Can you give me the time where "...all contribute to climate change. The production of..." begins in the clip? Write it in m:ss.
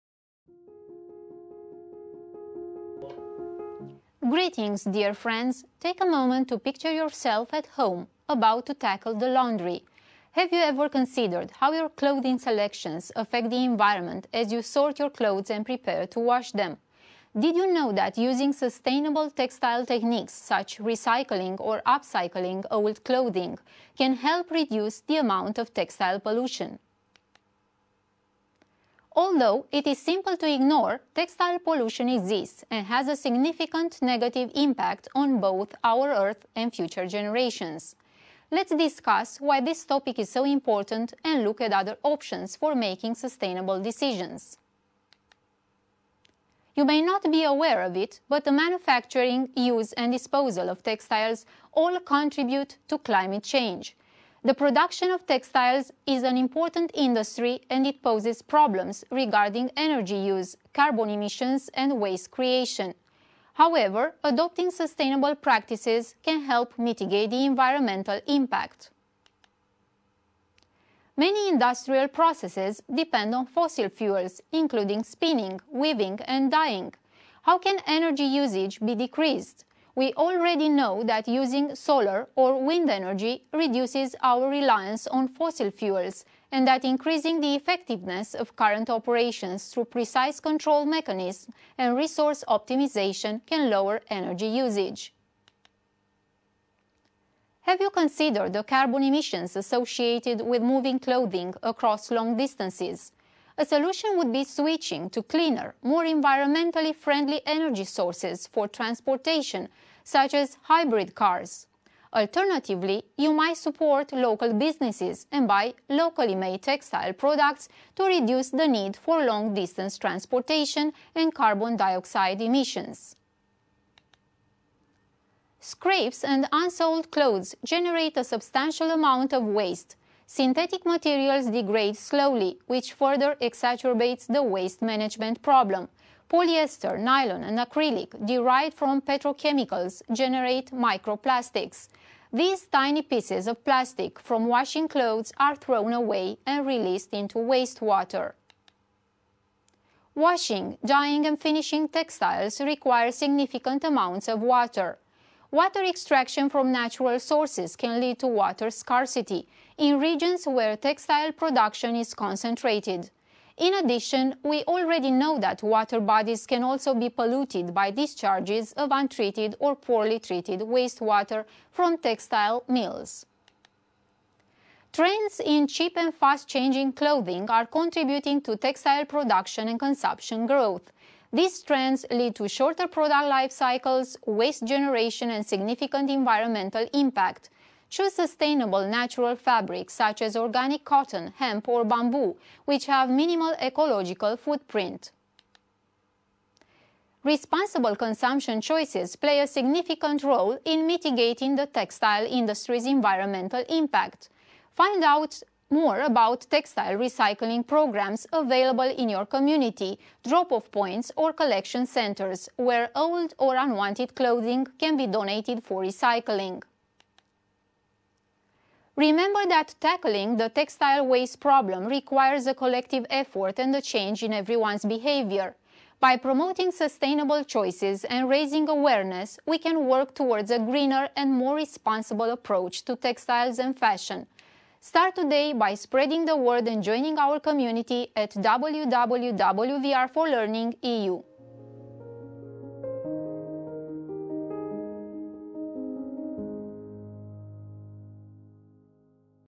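0:51.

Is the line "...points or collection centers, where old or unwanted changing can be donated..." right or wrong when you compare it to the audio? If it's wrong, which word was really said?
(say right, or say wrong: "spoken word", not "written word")
wrong: "clothing", not "changing".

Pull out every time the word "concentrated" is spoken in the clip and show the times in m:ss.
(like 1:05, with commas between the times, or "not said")
2:42.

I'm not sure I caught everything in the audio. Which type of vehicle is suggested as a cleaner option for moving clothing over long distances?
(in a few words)
Hybrid cars.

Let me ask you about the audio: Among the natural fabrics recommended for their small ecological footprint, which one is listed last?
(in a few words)
Bamboo.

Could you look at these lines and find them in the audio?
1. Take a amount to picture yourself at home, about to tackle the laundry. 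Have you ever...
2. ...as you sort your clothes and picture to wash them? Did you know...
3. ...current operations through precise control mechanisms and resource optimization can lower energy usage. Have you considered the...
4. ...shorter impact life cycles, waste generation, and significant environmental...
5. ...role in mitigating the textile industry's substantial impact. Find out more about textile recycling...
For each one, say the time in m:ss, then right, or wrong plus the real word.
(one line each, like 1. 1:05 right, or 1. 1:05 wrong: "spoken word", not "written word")
1. 0:05 wrong: "moment", not "amount"
2. 0:14 wrong: "prepare", not "picture"
3. 1:28 right
4. 3:02 wrong: "product", not "impact"
5. 3:20 wrong: "environmental", not "substantial".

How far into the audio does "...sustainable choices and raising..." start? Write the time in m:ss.
3:46.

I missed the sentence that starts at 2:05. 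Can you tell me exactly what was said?
Scrapes and unsold clothes generate a substantial amount of waste, synthetic materials degrade slowly, which further exacerbates the waste management problem.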